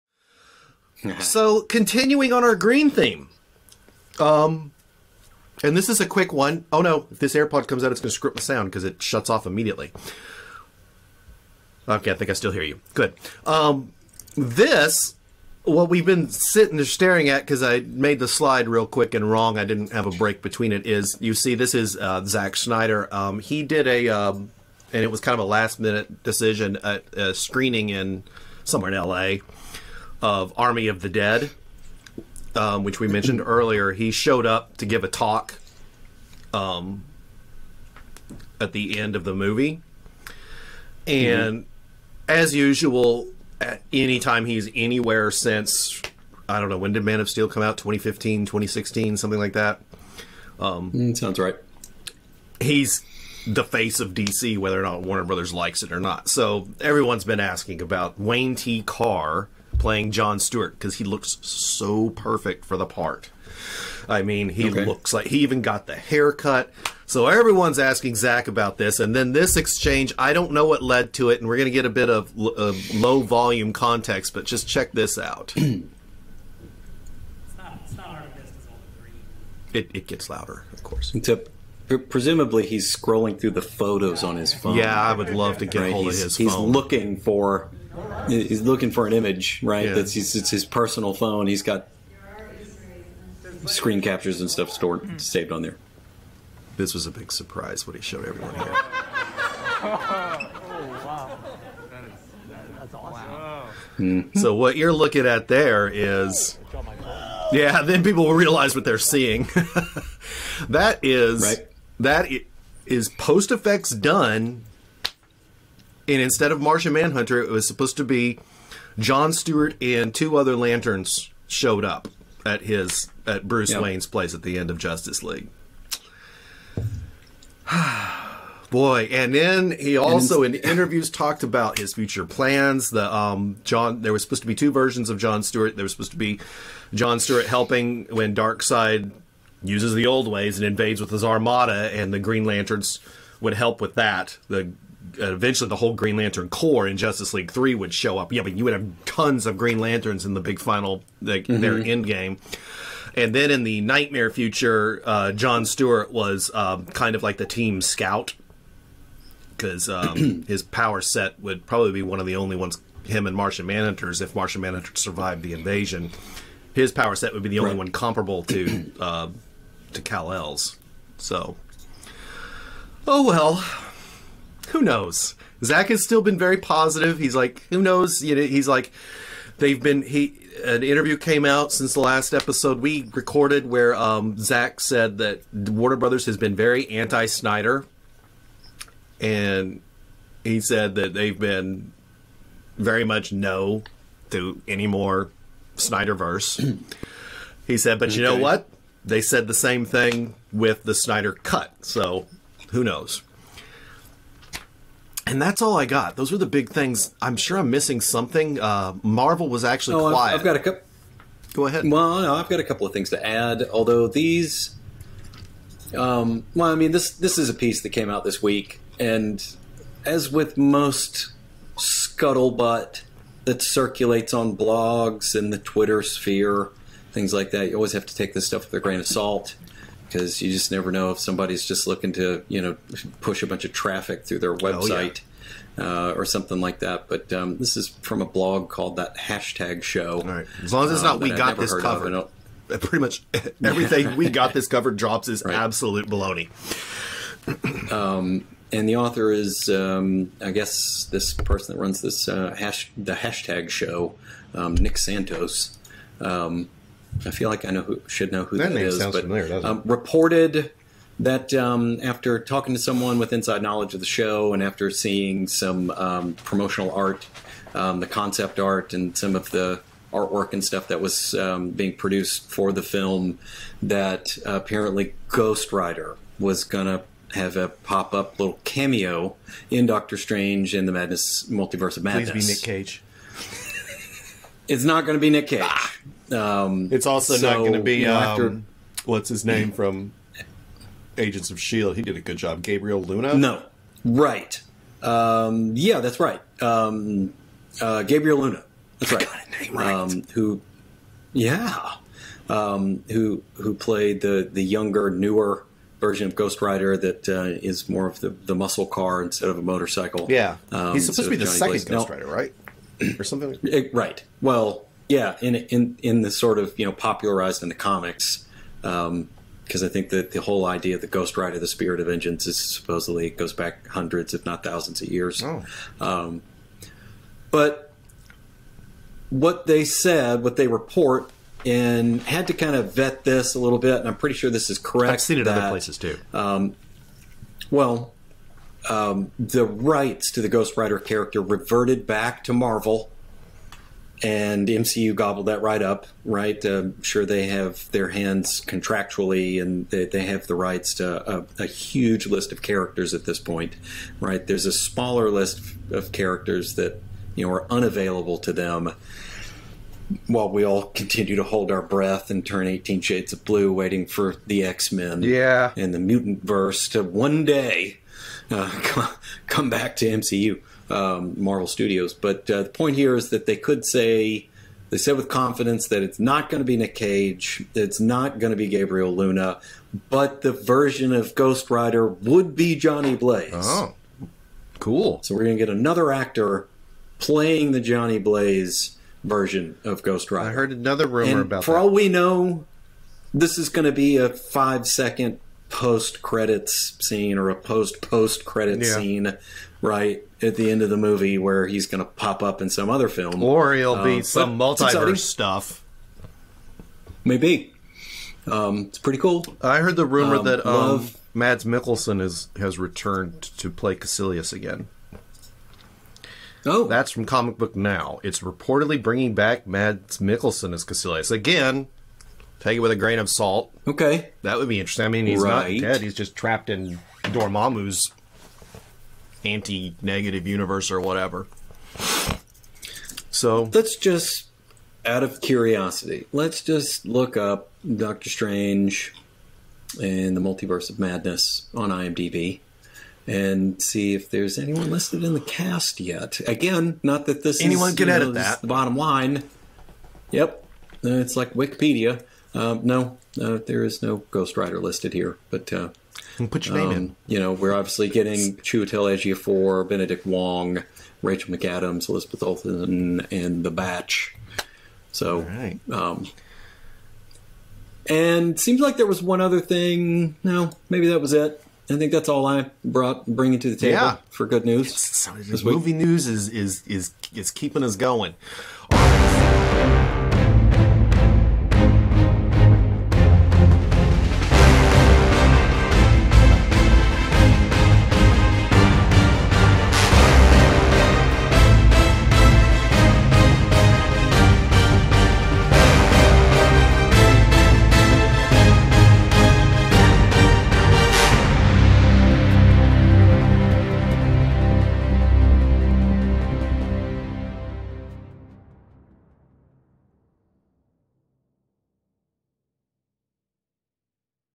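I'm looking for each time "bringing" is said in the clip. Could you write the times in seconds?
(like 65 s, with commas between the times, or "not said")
419 s, 473 s.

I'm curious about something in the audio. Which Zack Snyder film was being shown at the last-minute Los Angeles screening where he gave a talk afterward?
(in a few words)
Army of the Dead.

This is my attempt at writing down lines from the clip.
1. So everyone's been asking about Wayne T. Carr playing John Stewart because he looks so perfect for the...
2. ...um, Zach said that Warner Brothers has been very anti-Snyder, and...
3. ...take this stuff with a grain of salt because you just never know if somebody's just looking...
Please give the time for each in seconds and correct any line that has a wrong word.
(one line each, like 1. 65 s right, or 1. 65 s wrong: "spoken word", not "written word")
1. 56 s right
2. 183 s right
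3. 228 s right.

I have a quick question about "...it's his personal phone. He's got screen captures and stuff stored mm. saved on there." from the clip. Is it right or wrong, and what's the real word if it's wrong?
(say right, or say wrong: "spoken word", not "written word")
right.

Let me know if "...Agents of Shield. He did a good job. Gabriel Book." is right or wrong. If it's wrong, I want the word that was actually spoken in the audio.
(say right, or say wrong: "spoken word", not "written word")
wrong: "Luna", not "Book".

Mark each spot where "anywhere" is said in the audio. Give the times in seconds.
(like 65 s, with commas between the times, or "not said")
44 s.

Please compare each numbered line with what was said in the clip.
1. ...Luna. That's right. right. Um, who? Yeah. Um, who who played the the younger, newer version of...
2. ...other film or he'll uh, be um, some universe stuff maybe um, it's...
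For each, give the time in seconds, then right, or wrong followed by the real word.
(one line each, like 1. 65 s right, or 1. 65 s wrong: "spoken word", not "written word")
1. 298 s right
2. 402 s wrong: "multiverse", not "universe".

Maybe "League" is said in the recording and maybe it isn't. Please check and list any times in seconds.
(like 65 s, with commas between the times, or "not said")
125 s, 147 s.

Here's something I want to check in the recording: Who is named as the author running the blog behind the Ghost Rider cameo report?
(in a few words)
Nick Santos.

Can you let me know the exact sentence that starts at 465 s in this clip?
So, um, and seems like there was one other thing.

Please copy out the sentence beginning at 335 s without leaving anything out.
I've seen it that, other places too.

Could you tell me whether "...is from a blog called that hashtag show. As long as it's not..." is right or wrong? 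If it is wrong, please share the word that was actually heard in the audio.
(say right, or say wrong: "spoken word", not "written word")
right.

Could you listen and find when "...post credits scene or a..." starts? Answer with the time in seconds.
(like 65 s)
395 s.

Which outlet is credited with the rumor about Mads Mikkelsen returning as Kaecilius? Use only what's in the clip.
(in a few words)
Comic Book Now.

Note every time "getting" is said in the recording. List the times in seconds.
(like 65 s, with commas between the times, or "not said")
458 s.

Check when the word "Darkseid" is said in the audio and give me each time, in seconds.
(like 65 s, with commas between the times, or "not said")
138 s.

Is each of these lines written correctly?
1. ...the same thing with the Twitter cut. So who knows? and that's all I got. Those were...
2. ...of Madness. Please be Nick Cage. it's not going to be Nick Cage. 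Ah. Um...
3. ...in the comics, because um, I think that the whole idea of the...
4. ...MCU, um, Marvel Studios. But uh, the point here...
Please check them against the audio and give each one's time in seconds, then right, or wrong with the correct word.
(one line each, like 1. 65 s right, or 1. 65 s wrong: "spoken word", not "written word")
1. 199 s wrong: "Snyder", not "Twitter"
2. 281 s right
3. 317 s right
4. 370 s right.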